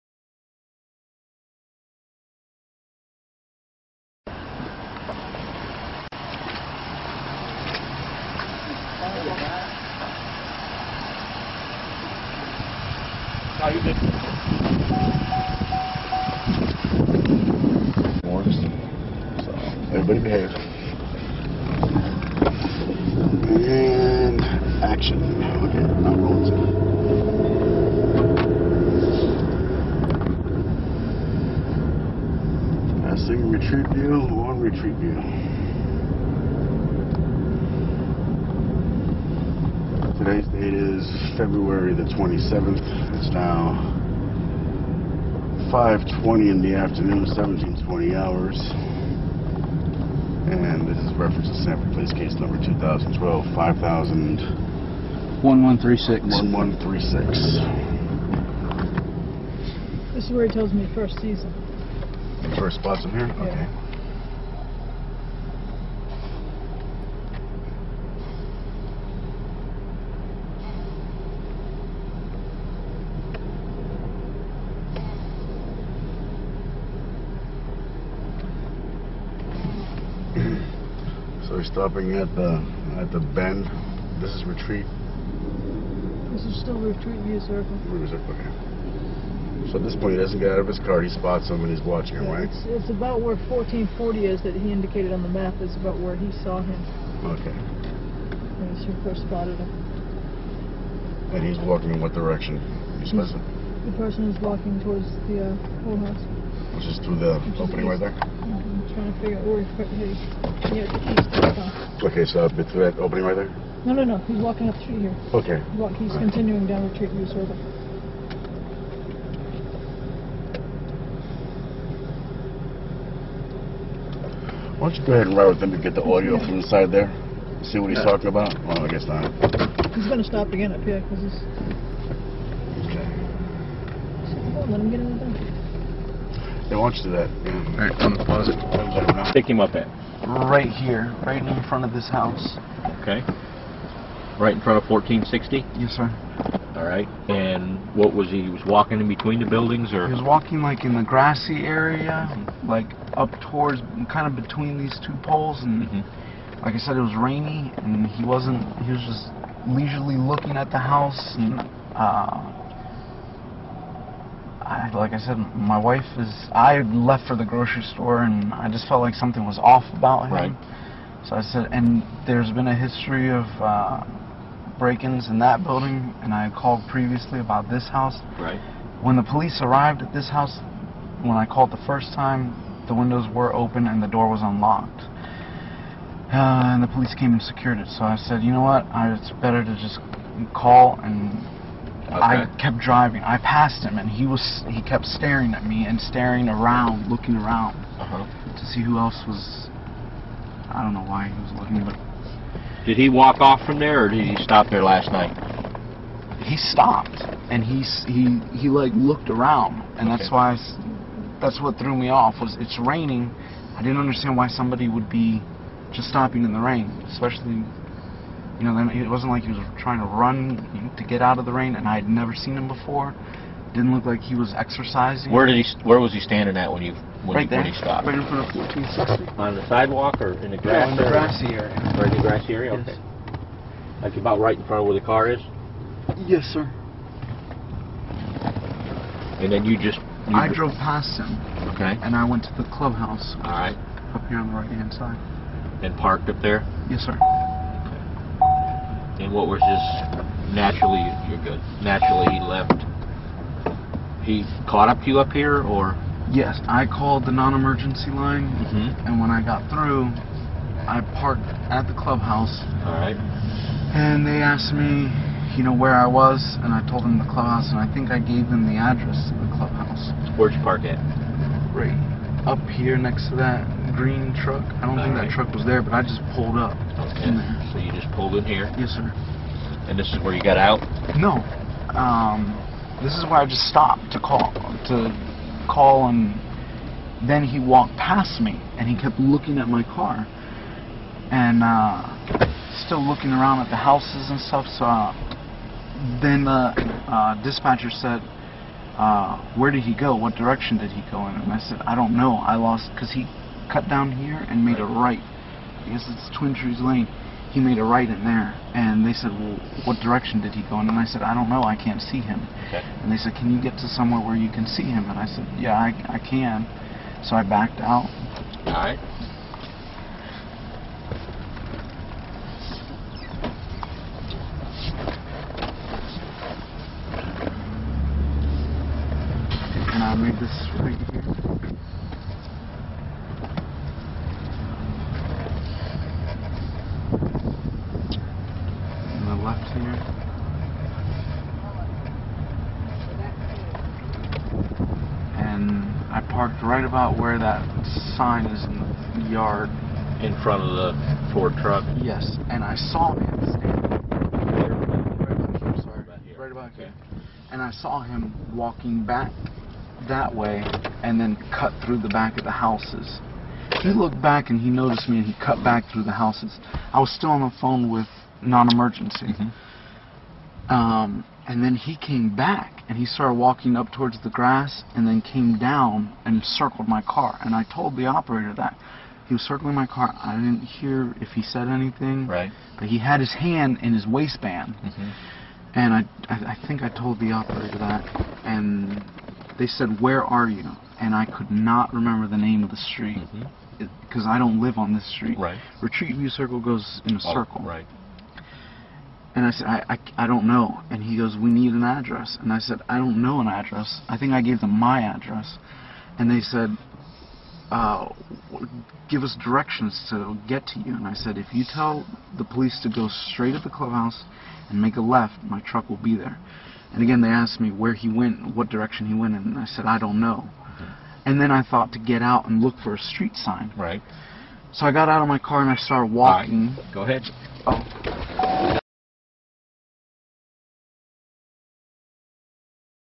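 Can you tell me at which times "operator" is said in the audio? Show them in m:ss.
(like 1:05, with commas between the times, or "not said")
6:18, 6:27.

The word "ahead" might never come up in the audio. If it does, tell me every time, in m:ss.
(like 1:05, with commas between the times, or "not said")
2:05, 7:07.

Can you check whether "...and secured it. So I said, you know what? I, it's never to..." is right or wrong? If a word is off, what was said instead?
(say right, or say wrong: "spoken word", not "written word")
wrong: "better", not "never".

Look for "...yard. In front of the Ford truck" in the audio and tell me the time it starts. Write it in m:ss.
5:49.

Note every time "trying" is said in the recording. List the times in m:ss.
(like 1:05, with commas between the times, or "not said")
1:48, 3:39.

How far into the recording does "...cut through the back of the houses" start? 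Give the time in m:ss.
6:01.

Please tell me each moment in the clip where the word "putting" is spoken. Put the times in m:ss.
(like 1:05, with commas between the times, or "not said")
1:49.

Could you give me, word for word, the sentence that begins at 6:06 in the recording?
I was still on the phone with non-emergency.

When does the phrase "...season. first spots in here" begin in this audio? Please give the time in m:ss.
1:01.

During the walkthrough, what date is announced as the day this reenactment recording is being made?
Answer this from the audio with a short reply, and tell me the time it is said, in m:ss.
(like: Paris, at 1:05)
February 27, at 0:41.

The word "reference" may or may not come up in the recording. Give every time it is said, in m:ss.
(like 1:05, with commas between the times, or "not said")
0:51.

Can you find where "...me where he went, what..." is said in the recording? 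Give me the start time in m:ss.
6:57.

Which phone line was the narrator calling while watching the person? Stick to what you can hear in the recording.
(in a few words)
Non-emergency line.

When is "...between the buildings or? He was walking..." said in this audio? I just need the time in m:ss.
2:29.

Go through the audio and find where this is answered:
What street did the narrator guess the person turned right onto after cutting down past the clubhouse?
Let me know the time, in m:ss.
5:06.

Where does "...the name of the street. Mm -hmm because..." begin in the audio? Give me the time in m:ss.
6:32.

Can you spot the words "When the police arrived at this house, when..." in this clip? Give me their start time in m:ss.
2:59.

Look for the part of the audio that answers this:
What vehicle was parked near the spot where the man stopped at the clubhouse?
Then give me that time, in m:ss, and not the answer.
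4:34.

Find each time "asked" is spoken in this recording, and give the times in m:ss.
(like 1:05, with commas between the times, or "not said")
4:24, 6:57.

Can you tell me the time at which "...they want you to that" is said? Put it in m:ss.
2:16.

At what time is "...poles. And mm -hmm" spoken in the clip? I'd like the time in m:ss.
2:35.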